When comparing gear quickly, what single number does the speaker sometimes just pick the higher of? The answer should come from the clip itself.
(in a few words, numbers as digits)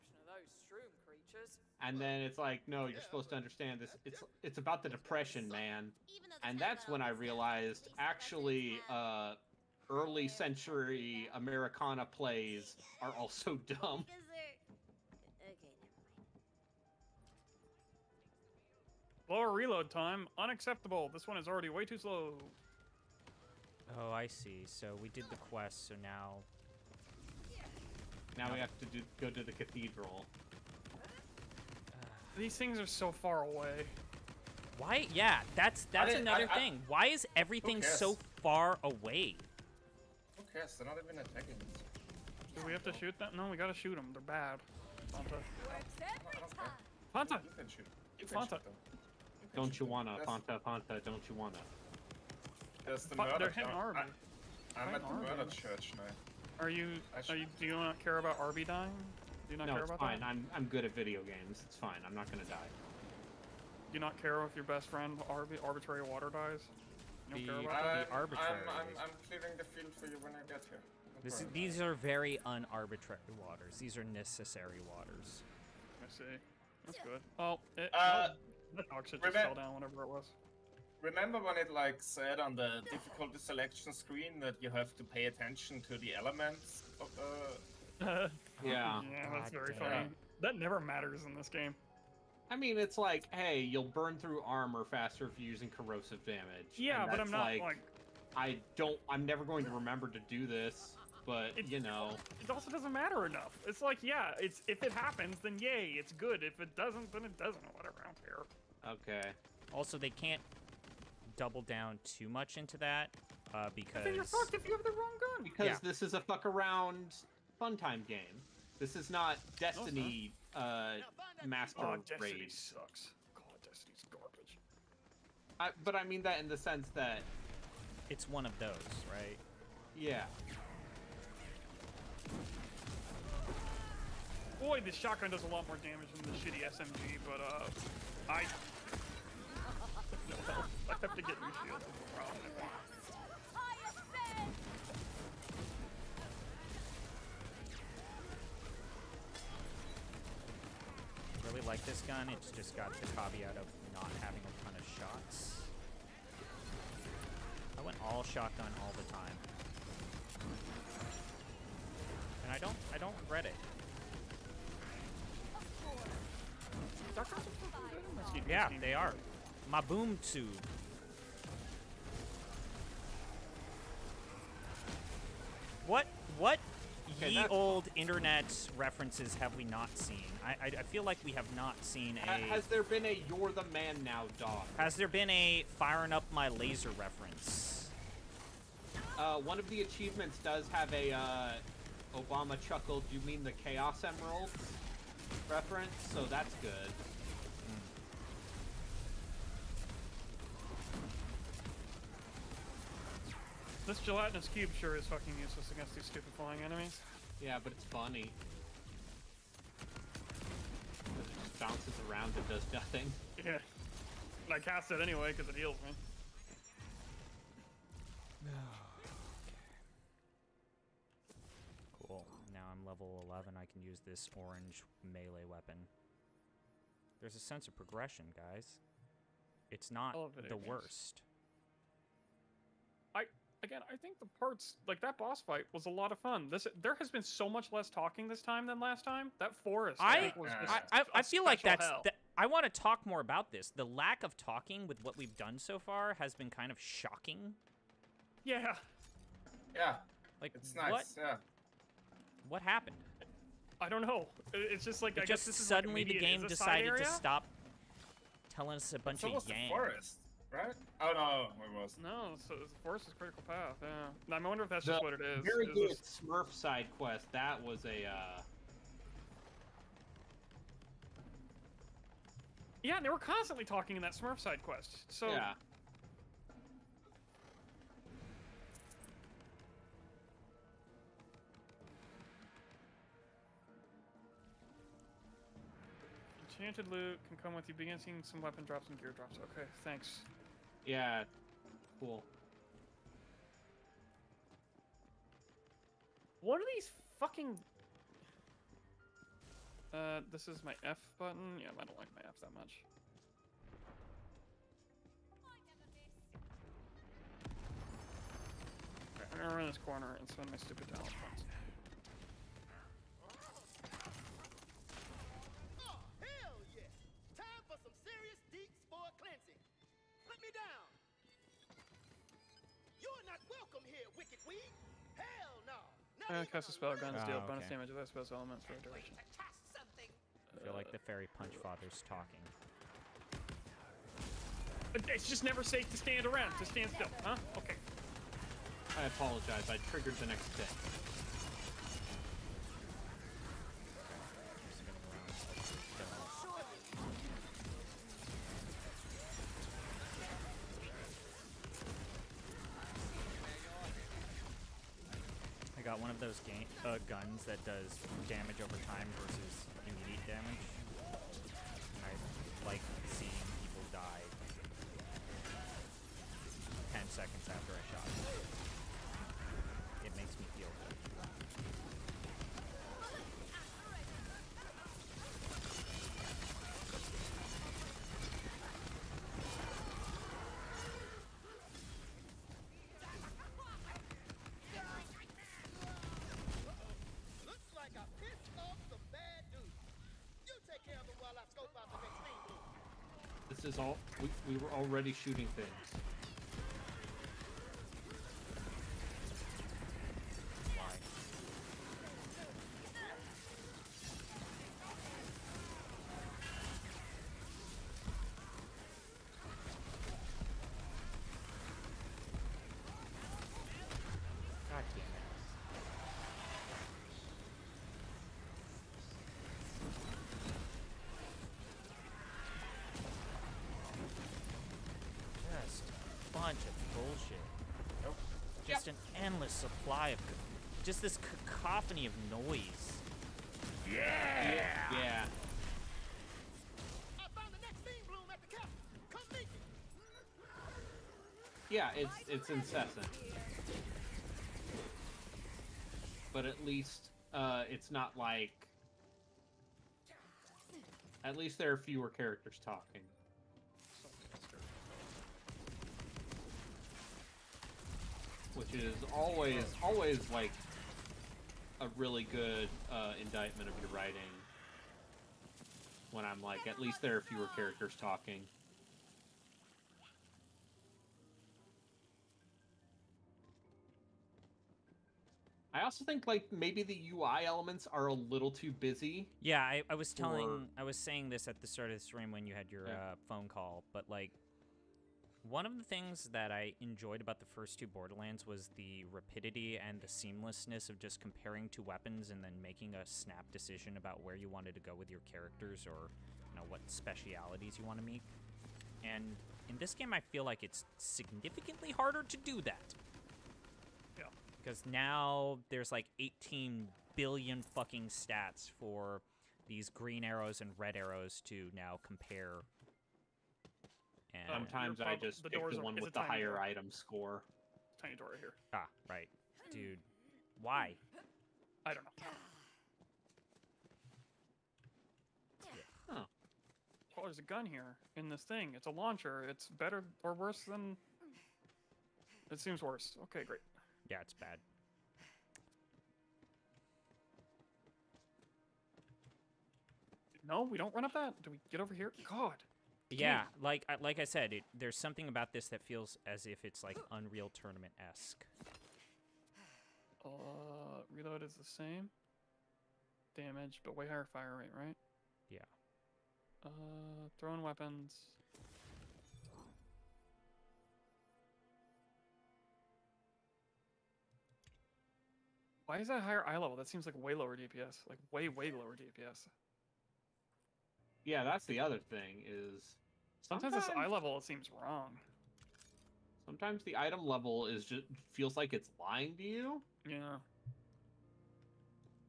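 item score.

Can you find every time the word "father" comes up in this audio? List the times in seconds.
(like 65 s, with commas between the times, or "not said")
331 s.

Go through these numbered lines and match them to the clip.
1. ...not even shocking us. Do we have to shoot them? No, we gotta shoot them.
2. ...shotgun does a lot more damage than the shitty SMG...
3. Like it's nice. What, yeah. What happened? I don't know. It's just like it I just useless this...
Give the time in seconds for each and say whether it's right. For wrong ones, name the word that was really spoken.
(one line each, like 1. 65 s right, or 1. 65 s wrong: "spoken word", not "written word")
1. 40 s wrong: "attacking", not "shocking"
2. 134 s right
3. 250 s wrong: "guess", not "useless".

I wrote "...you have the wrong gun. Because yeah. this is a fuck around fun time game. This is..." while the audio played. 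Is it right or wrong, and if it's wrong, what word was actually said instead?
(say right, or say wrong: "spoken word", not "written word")
right.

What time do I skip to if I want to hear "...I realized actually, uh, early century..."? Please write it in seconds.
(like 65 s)
7 s.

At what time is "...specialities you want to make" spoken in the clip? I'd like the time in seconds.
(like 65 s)
496 s.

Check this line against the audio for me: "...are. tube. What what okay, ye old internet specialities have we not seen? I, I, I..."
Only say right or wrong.
wrong.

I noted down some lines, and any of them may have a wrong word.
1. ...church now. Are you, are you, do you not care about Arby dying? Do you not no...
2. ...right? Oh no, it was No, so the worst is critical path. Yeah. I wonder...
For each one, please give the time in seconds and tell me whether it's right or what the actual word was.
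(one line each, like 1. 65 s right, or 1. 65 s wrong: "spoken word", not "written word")
1. 55 s right
2. 260 s wrong: "forest", not "worst".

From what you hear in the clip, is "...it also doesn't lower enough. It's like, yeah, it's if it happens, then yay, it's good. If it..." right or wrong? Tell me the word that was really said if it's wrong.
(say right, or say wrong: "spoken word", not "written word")
wrong: "matter", not "lower".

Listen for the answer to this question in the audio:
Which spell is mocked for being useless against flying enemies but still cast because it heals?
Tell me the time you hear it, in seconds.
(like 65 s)
204 s.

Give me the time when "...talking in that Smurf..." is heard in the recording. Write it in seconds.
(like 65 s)
273 s.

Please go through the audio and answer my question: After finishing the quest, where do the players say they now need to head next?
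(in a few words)
the cathedral.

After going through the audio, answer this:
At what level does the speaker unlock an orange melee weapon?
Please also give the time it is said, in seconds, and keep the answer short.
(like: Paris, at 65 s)
11, at 222 s.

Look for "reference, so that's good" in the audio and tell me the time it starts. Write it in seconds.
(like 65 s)
195 s.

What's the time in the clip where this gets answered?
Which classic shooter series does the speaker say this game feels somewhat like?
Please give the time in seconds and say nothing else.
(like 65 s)
547 s.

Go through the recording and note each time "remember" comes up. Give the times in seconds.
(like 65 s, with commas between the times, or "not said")
81 s, 99 s.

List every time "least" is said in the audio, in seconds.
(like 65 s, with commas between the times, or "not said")
446 s, 451 s, 466 s.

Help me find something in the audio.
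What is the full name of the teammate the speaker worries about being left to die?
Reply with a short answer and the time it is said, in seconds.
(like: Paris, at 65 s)
Arbitrary Water, at 65 s.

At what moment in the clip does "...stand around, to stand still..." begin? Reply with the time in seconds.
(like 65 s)
335 s.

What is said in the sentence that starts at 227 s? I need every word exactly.
There's a sense of progression, guys.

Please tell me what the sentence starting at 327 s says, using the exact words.
bonus damage without spell's elements for a duration.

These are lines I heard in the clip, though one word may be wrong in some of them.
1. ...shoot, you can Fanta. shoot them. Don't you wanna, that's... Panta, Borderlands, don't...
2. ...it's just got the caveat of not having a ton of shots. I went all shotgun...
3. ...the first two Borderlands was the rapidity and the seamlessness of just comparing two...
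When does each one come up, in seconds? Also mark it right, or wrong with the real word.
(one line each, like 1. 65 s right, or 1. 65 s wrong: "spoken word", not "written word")
1. 47 s wrong: "Panta", not "Borderlands"
2. 152 s right
3. 487 s right.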